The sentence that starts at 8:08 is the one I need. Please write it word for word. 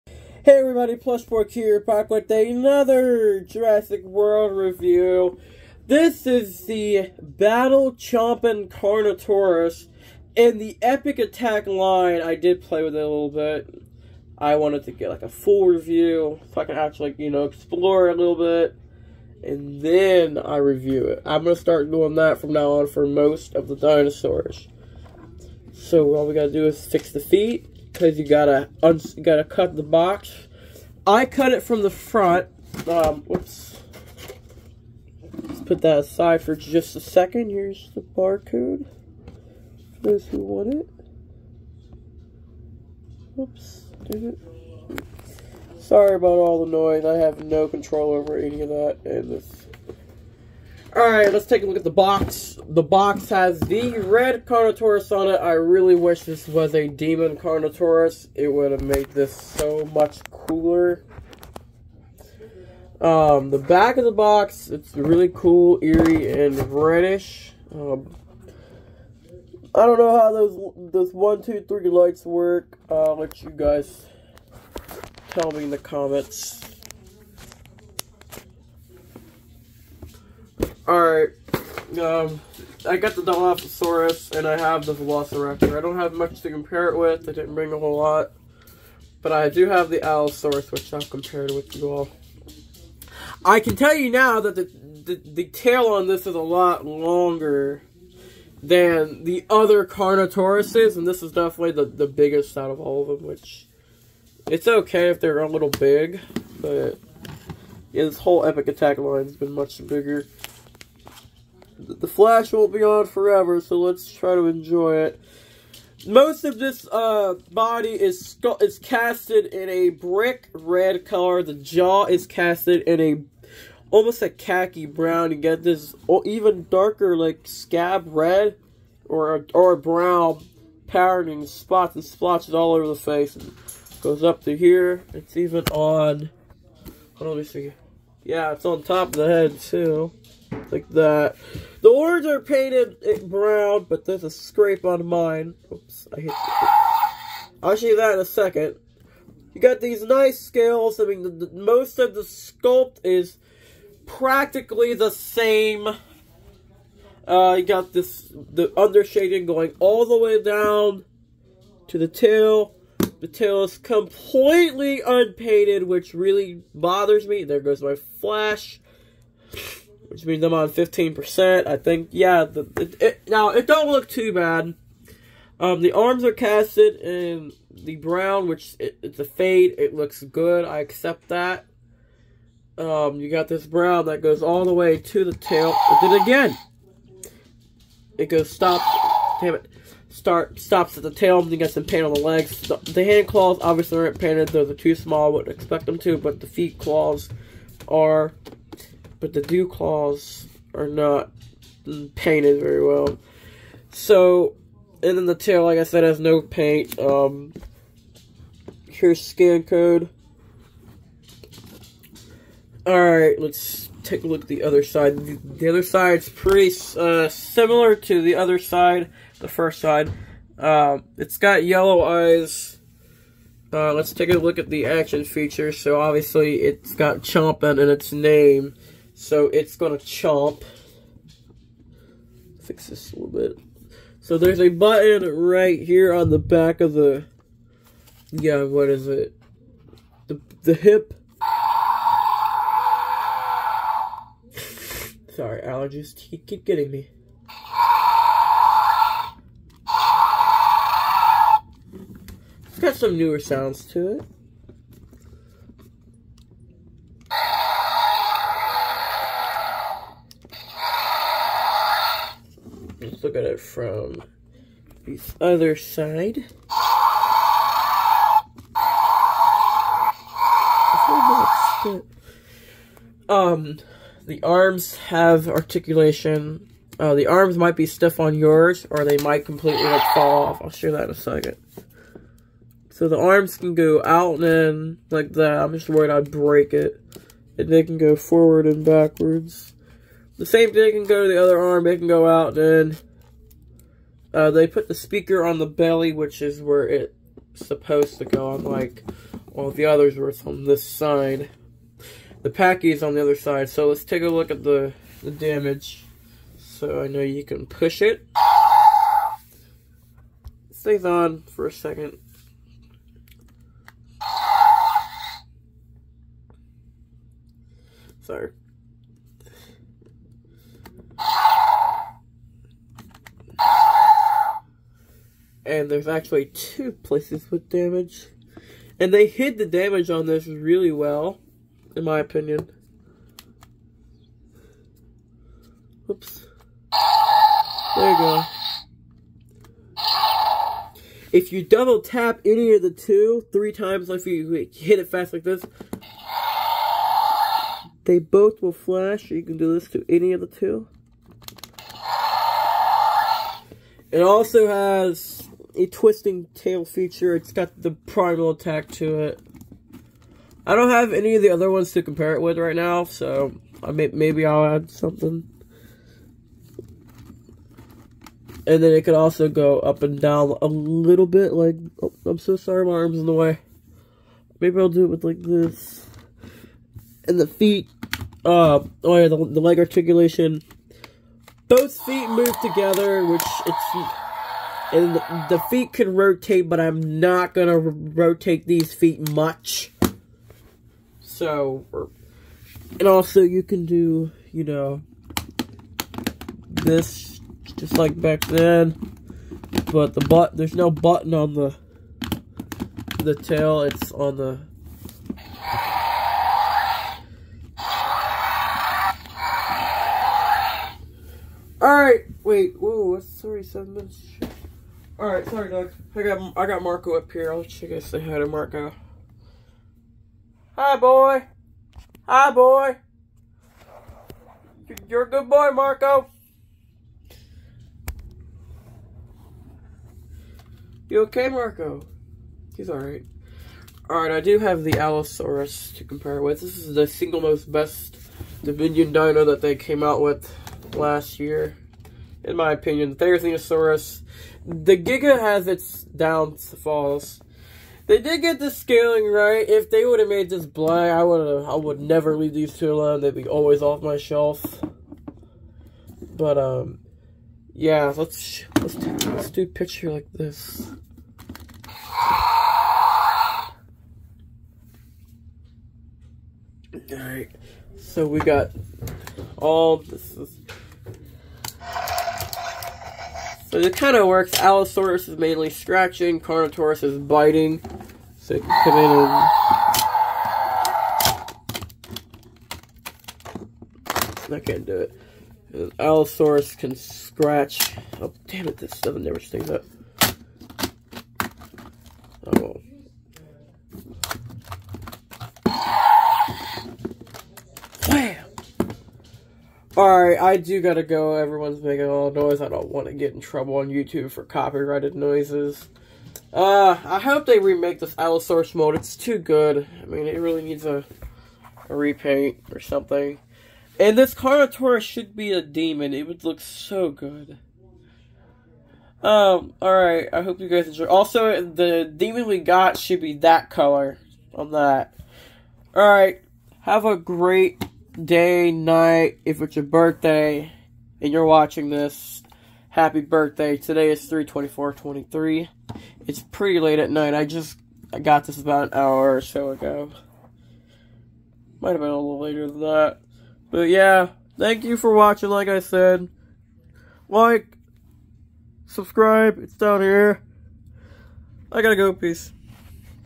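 Oh, damn it, this stuff never stays up.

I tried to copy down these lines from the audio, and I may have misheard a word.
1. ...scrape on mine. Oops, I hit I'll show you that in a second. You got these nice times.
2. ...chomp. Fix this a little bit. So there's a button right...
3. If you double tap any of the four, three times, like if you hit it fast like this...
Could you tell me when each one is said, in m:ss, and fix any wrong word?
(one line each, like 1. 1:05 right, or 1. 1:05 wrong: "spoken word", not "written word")
1. 2:24 wrong: "scales", not "times"
2. 3:50 right
3. 5:41 wrong: "two", not "four".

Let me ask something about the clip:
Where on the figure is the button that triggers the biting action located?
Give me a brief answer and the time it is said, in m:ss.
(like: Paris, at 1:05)
the hip, at 4:00.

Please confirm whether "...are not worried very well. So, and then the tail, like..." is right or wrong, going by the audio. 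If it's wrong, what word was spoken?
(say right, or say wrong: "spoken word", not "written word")
wrong: "painted", not "worried".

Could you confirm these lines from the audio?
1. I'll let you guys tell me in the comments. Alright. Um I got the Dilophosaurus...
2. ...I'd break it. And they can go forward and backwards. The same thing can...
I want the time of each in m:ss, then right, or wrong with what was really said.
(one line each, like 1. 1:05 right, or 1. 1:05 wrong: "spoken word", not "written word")
1. 1:12 right
2. 4:46 right.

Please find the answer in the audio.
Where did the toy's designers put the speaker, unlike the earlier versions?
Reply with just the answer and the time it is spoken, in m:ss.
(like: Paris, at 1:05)
the belly, at 4:55.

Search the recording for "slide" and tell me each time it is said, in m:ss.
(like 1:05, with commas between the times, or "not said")
not said.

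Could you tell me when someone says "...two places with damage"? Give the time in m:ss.
5:26.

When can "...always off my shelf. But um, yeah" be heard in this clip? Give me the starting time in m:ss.
7:33.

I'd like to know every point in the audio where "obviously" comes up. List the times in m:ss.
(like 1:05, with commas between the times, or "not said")
3:13, 3:45.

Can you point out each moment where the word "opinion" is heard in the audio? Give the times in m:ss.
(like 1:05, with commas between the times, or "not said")
5:32, 7:22.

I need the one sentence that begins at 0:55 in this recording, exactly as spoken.
I really wish this was a demon Carnotaurus.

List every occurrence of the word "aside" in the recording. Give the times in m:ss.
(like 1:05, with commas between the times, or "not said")
0:35.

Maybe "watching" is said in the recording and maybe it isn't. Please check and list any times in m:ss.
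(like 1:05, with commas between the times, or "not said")
8:51, 9:05.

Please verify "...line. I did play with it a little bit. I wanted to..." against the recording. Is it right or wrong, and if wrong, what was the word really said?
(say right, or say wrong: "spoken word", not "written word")
right.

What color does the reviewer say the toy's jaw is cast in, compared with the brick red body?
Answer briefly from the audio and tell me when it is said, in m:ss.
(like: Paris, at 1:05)
khaki brown, at 2:04.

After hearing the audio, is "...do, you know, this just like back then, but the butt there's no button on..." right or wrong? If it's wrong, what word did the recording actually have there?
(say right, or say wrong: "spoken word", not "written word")
right.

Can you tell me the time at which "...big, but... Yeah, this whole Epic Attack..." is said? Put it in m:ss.
1:45.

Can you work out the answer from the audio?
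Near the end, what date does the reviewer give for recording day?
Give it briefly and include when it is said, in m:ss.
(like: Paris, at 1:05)
324.23, at 8:54.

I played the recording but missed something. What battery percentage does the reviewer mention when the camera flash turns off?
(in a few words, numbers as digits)
15%.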